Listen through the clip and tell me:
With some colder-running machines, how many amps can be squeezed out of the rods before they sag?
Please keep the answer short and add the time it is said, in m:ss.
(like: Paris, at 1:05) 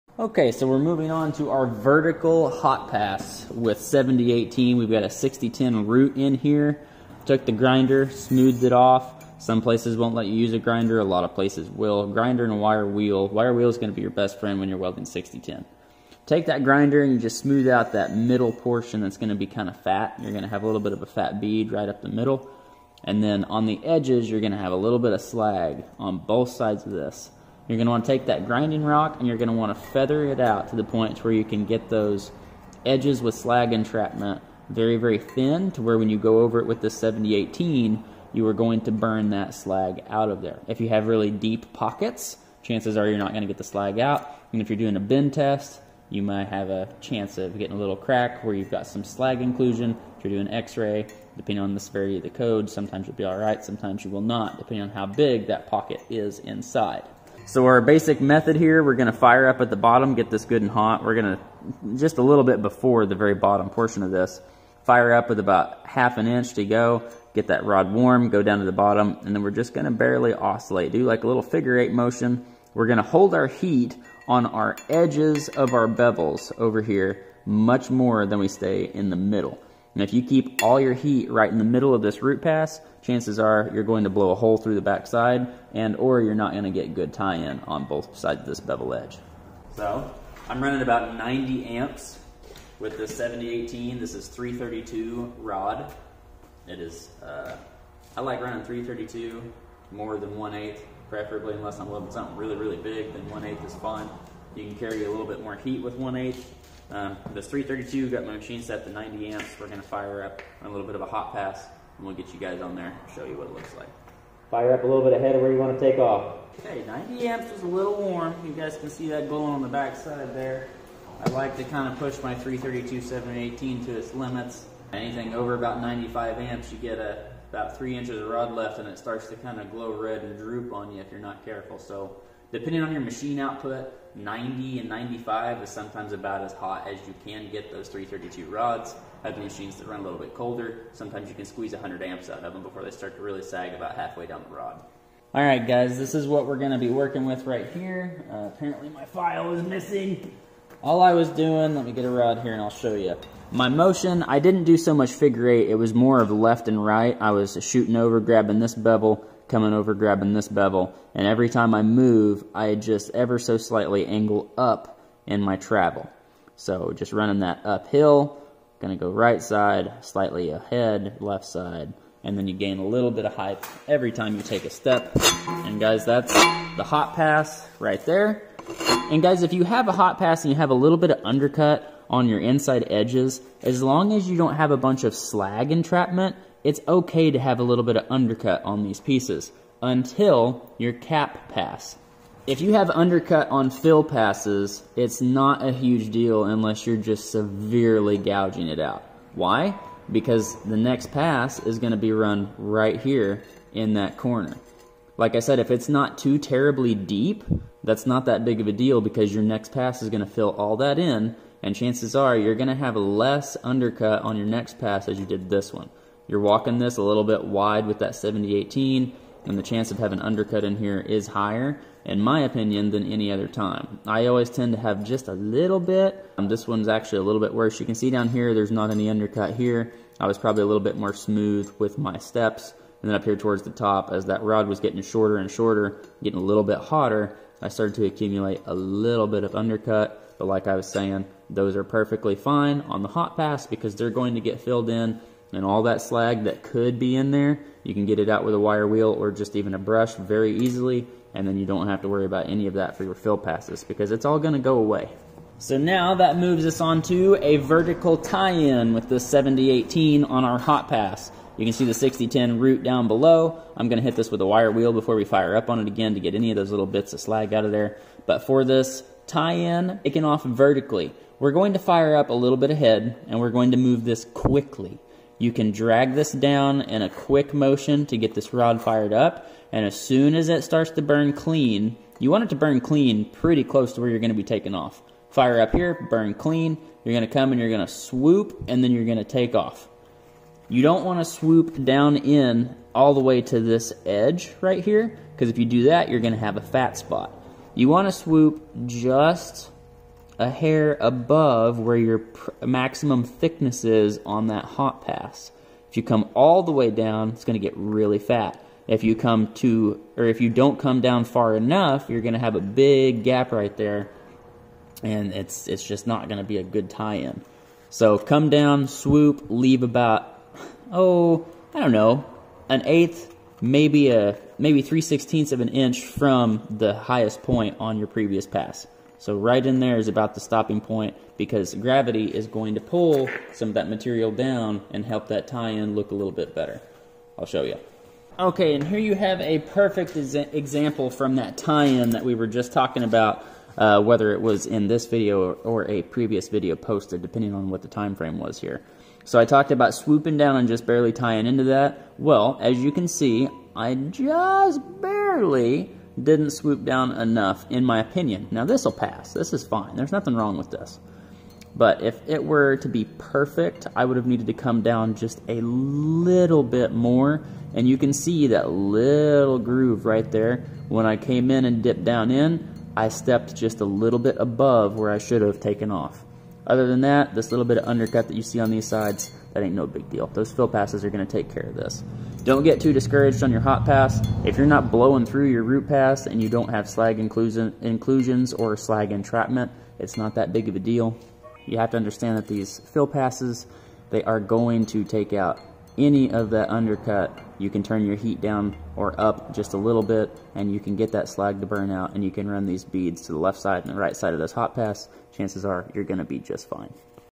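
100 amps, at 2:21.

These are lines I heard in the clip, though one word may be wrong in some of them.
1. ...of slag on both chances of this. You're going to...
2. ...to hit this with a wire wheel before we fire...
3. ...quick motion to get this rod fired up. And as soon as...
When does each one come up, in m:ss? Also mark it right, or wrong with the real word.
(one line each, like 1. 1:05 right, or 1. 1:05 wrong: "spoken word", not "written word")
1. 0:25 wrong: "sides", not "chances"
2. 4:23 right
3. 4:37 right.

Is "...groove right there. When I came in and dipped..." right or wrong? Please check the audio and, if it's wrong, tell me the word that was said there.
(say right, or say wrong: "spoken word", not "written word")
right.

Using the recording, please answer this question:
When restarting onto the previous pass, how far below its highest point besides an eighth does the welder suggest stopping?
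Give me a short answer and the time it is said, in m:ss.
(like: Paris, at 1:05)
3/16 inch, at 5:24.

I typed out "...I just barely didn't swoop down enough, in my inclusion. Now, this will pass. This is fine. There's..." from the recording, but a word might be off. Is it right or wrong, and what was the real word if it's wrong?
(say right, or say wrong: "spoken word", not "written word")
wrong: "opinion", not "inclusion".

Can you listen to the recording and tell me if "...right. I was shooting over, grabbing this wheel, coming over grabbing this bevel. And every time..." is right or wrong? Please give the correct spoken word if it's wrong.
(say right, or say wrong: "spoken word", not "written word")
wrong: "bevel", not "wheel".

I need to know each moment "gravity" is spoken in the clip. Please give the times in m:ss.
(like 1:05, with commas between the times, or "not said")
5:31.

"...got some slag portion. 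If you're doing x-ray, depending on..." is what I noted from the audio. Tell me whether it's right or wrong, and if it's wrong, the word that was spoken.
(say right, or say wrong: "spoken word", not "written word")
wrong: "inclusion", not "portion".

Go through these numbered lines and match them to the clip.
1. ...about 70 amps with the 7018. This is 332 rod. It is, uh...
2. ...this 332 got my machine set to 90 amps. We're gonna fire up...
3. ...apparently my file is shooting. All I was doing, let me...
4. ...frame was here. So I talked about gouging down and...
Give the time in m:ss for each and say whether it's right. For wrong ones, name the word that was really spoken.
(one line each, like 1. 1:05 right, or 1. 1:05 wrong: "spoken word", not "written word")
1. 1:30 wrong: "90", not "70"
2. 1:47 right
3. 2:28 wrong: "missing", not "shooting"
4. 5:48 wrong: "swooping", not "gouging".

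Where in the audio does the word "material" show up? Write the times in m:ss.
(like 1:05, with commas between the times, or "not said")
5:33.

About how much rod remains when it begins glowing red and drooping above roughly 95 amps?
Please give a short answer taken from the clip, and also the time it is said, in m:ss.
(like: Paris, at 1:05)
3 inches, at 2:07.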